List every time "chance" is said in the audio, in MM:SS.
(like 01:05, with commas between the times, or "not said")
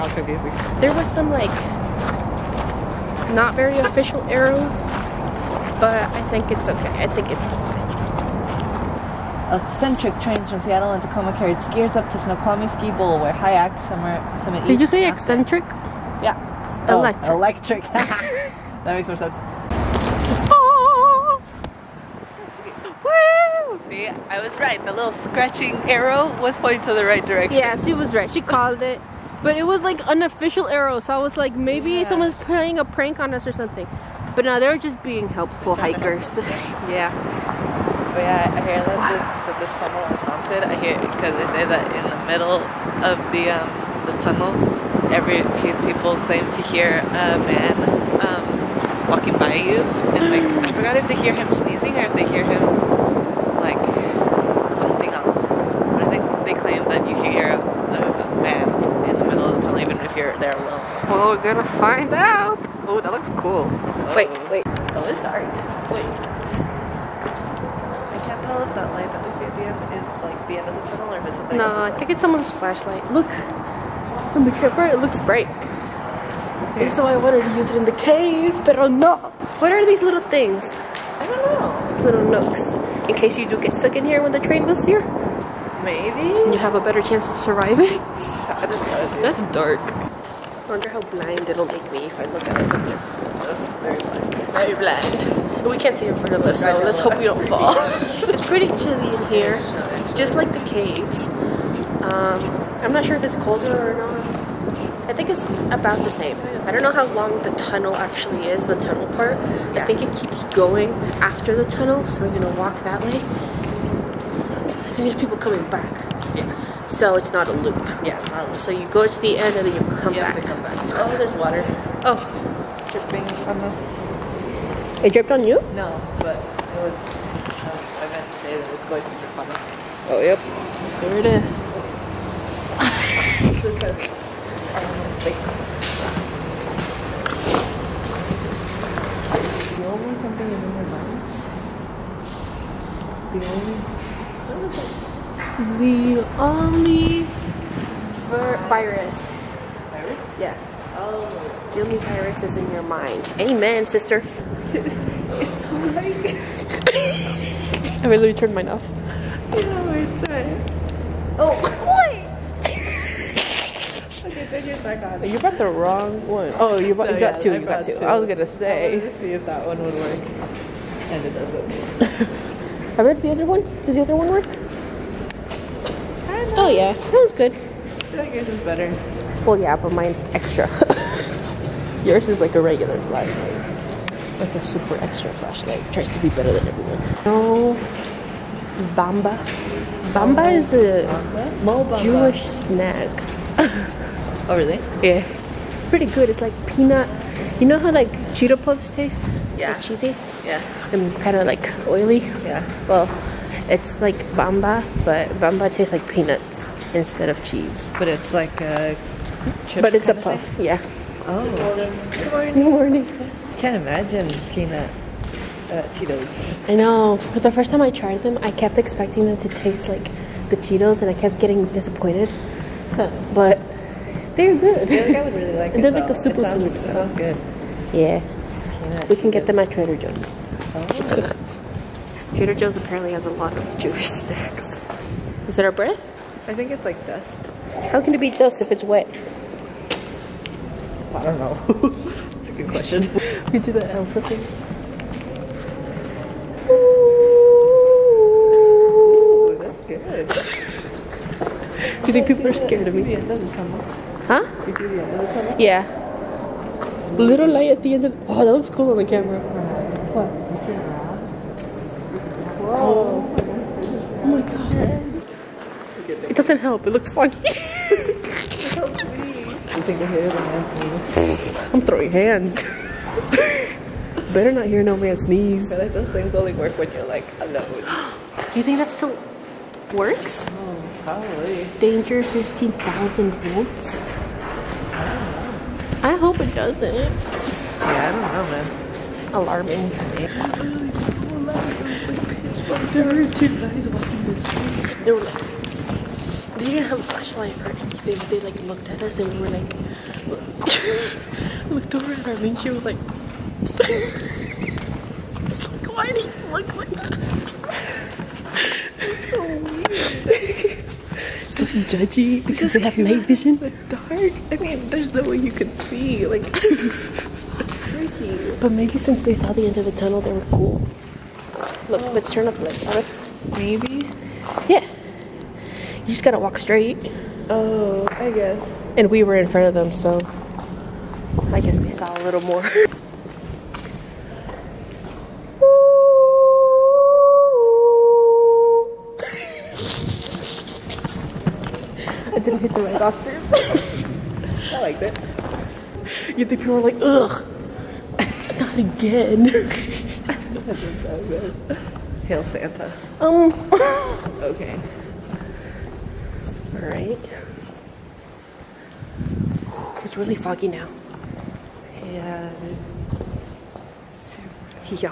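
01:26.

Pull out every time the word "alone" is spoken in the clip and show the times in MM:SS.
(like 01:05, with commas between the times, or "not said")
01:00, 04:37.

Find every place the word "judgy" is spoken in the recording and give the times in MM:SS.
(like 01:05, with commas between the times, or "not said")
05:11.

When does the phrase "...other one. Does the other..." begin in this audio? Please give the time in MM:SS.
02:53.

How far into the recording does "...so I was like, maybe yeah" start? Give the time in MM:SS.
00:30.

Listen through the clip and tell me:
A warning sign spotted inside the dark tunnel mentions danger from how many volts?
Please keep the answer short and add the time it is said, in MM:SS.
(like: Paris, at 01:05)
15,000, at 04:42.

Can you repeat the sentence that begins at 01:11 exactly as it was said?
No, I think it's someone's flashlight.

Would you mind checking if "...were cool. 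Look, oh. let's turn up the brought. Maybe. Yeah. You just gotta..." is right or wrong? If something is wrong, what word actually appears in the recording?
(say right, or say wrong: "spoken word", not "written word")
wrong: "light", not "brought".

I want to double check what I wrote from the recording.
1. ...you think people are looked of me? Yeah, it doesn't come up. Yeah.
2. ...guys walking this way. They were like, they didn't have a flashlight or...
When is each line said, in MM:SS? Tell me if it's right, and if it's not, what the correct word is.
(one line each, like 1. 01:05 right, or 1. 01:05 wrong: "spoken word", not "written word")
1. 04:12 wrong: "scared", not "looked"
2. 04:53 right.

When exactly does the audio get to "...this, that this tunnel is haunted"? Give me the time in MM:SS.
00:39.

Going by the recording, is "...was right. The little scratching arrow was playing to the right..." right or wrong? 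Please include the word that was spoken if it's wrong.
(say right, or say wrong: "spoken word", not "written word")
wrong: "pointing", not "playing".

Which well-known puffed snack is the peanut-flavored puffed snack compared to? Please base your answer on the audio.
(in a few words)
Cheeto Puffs.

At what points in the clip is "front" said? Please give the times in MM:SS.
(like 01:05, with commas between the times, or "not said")
01:36, 05:29.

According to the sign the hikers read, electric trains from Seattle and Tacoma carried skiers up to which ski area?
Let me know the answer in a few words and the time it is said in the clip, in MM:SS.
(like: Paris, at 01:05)
Snoqualmie Ski Bowl, at 00:12.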